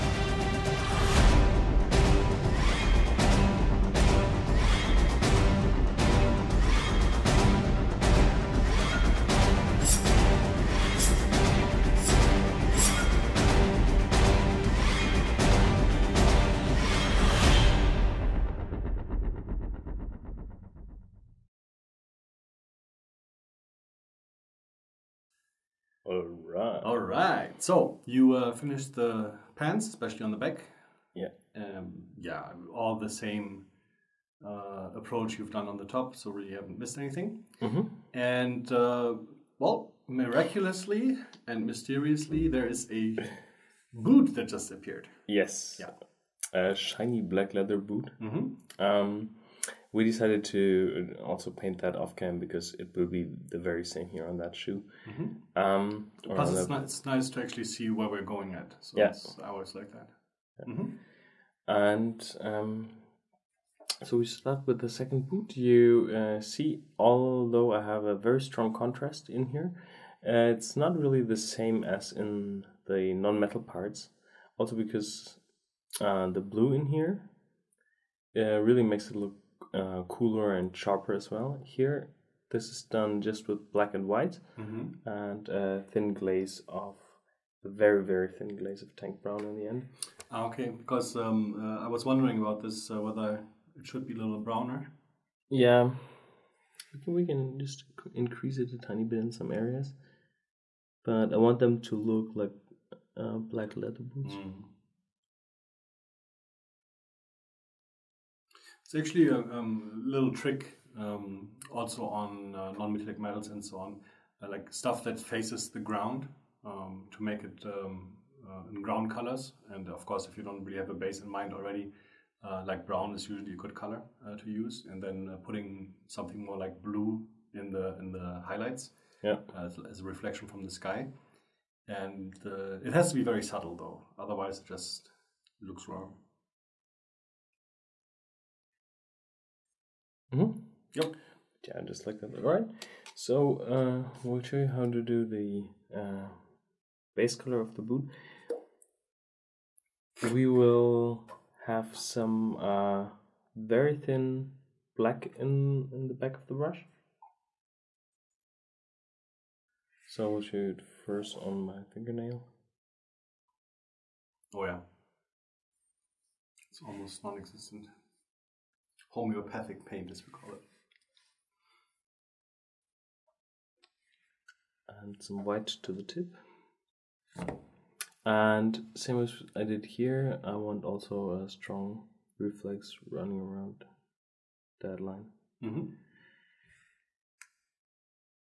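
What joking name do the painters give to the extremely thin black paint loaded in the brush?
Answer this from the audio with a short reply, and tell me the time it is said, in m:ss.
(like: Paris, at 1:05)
Homeopathic paint, at 2:49.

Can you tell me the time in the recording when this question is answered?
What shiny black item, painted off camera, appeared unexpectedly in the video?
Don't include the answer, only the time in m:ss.
0:47.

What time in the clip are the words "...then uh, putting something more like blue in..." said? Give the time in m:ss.
2:05.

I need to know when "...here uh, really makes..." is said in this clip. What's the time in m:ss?
1:16.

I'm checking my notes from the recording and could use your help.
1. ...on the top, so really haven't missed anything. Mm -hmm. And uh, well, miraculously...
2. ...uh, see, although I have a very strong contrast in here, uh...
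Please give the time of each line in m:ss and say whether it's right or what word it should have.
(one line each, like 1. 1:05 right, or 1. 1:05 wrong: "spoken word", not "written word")
1. 0:35 right
2. 1:06 right.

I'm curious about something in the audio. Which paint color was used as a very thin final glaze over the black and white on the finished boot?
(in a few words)
Tank brown.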